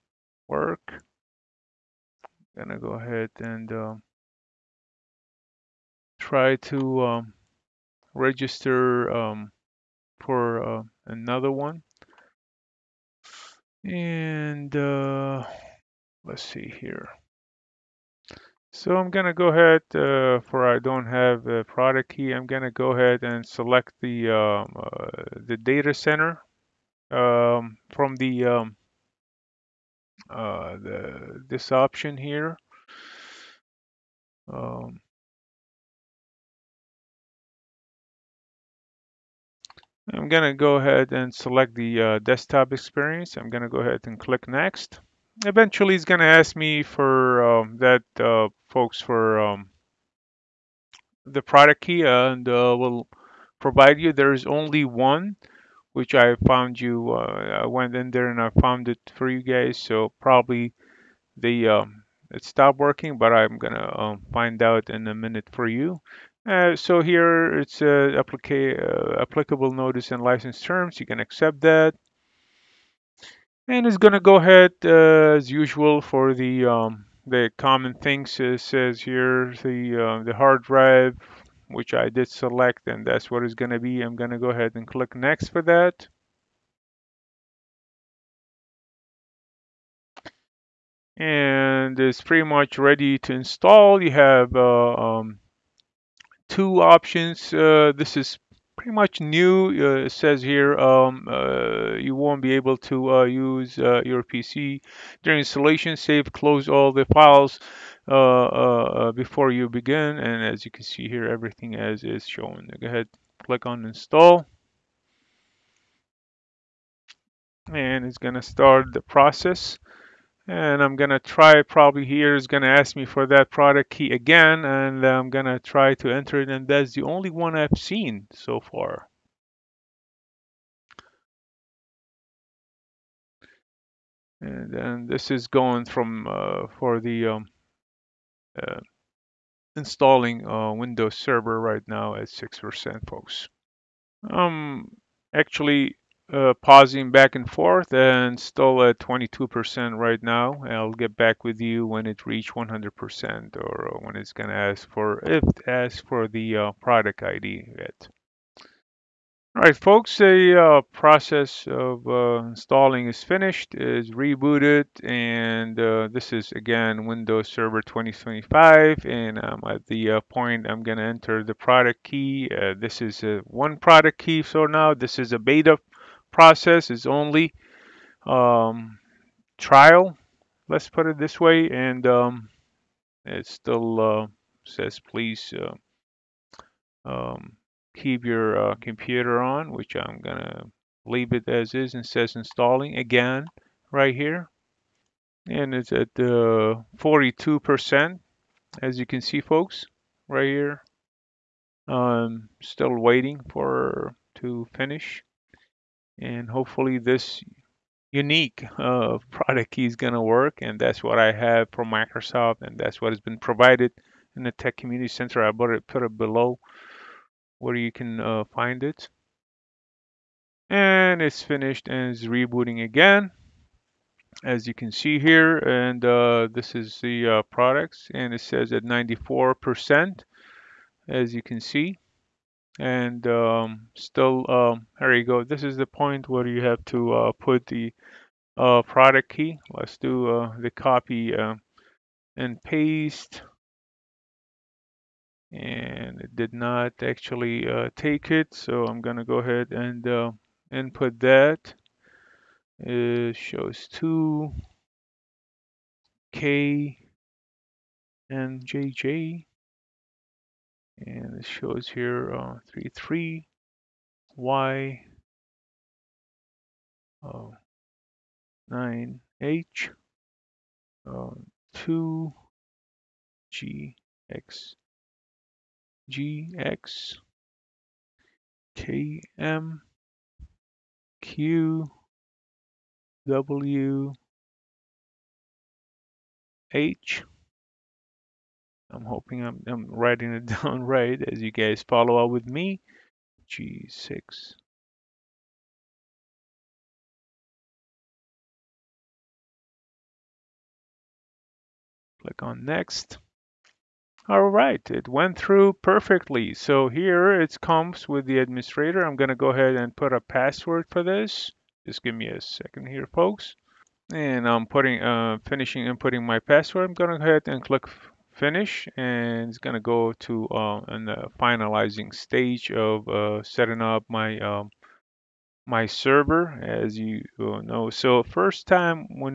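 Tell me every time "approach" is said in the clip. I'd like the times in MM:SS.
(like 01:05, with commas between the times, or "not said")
not said.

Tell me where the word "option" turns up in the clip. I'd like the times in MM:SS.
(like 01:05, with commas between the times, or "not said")
00:31, 01:36.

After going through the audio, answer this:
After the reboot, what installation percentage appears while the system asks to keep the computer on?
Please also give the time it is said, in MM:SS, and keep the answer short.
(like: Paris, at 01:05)
42%, at 03:16.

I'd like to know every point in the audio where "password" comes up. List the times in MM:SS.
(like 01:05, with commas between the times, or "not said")
05:10, 05:16.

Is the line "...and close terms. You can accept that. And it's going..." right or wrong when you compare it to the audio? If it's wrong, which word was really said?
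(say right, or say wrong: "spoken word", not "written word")
wrong: "license", not "close".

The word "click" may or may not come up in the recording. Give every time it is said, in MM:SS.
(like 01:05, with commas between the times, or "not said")
00:44, 01:24, 01:53, 05:02, 05:17.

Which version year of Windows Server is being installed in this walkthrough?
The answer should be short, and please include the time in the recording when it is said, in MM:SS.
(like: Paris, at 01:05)
2025, at 02:47.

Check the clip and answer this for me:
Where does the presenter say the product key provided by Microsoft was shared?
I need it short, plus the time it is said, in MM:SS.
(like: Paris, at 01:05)
Tech community center, at 03:34.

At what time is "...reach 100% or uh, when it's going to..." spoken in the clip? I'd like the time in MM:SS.
02:32.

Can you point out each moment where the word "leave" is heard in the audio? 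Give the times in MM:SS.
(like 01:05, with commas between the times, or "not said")
03:11.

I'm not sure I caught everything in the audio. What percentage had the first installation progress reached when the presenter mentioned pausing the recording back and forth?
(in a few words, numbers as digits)
22%.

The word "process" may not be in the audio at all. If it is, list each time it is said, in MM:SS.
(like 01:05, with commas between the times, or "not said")
01:59, 02:40, 02:56.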